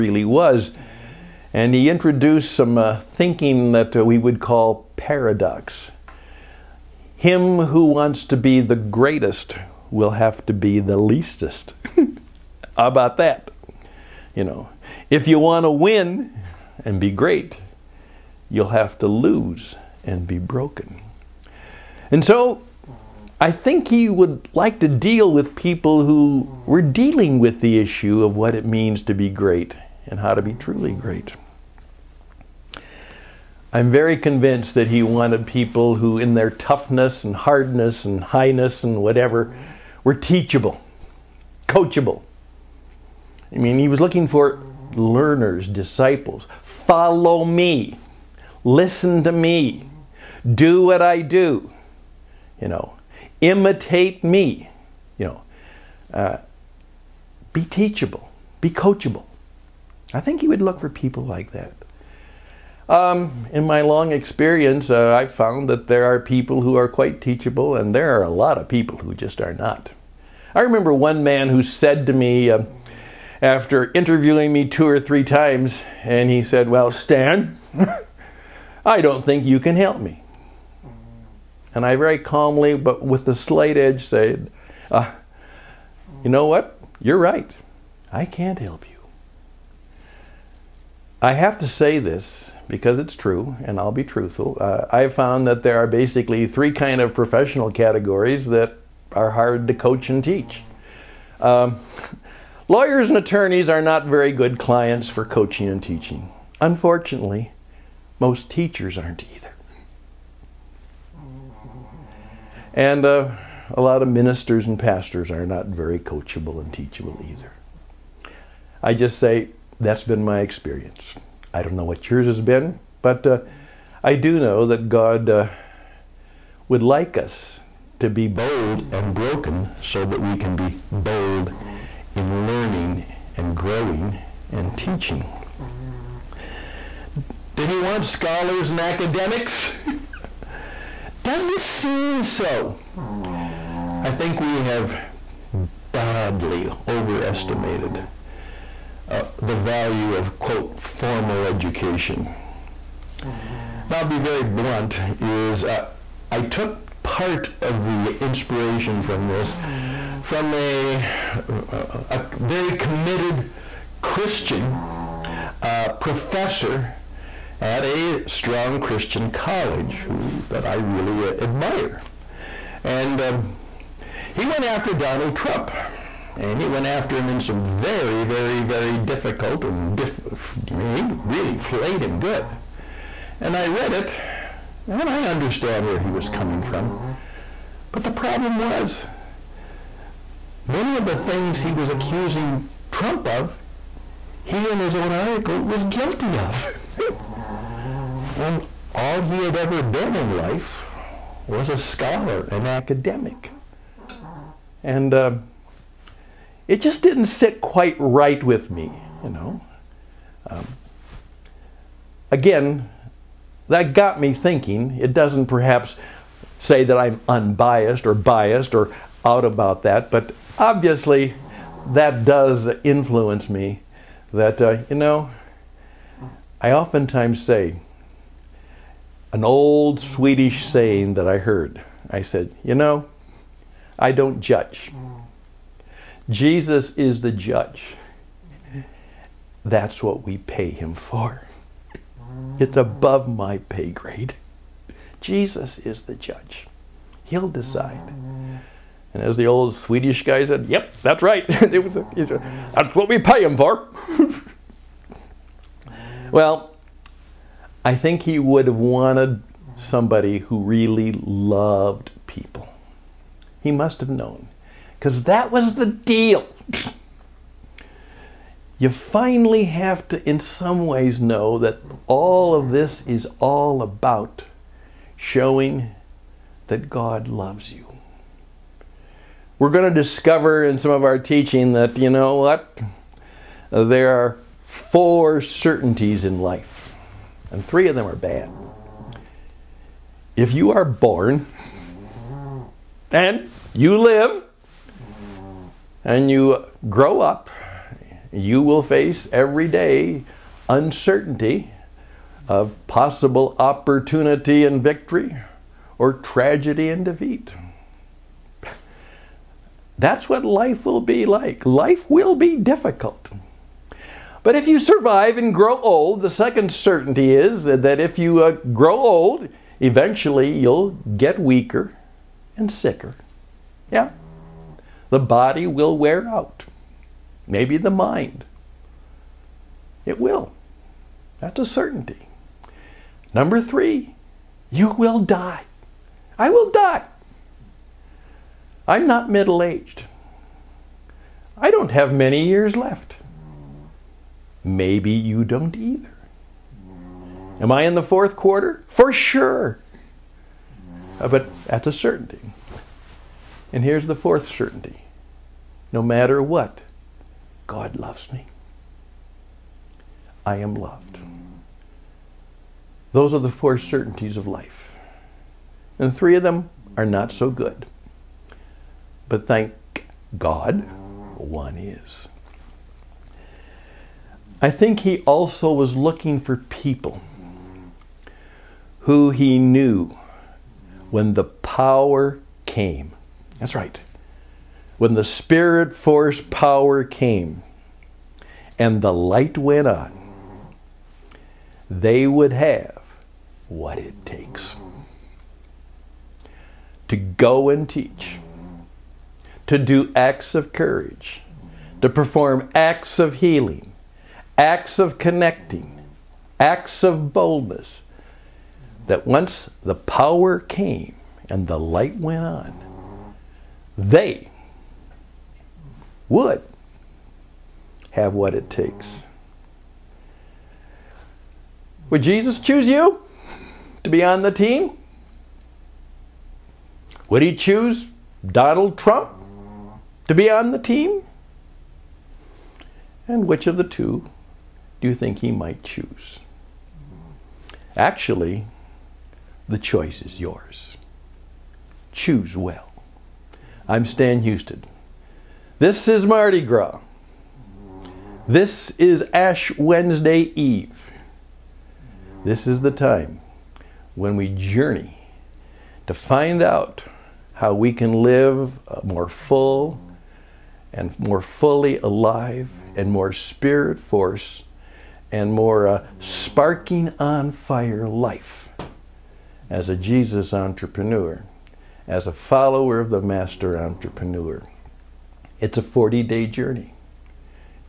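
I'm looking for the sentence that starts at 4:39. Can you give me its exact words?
We're going to discover in some of our teaching that, you know what?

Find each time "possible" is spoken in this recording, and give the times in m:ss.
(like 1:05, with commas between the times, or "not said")
5:02.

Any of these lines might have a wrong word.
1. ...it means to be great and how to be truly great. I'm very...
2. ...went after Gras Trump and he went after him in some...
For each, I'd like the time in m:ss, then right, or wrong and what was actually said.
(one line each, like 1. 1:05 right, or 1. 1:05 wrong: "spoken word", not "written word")
1. 0:28 right
2. 2:54 wrong: "Donald", not "Gras".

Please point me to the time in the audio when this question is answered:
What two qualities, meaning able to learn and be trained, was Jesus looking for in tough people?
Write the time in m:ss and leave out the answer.
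0:40.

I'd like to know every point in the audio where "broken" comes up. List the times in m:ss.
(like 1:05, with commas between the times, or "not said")
0:20, 2:09.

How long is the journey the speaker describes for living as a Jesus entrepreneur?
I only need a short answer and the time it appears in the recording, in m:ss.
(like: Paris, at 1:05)
40 days, at 7:55.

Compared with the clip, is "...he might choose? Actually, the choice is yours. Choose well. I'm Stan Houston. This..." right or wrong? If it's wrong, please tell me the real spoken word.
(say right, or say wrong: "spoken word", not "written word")
right.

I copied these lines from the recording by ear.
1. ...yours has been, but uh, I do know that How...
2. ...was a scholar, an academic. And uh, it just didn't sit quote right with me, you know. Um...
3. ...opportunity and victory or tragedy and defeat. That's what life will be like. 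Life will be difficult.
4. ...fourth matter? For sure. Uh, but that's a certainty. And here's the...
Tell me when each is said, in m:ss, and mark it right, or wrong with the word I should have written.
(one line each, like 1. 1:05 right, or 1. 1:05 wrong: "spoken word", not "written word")
1. 2:02 wrong: "God", not "How"
2. 3:21 wrong: "quite", not "quote"
3. 5:03 right
4. 5:48 wrong: "quarter", not "matter".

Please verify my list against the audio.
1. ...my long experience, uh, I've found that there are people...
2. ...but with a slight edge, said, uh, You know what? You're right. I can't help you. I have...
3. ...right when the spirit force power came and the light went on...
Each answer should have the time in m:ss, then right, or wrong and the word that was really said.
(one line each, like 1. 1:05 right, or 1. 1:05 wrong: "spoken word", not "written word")
1. 1:03 right
2. 1:22 right
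3. 6:23 right.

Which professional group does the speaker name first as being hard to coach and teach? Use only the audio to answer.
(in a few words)
lawyers and attorneys.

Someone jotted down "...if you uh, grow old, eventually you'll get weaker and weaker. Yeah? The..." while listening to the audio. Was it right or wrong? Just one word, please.
wrong.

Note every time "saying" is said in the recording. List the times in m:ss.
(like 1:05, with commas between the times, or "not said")
3:50.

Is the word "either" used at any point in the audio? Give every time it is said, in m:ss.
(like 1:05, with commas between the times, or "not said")
1:49, 1:57, 5:45.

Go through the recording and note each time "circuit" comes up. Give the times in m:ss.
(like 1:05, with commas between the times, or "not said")
not said.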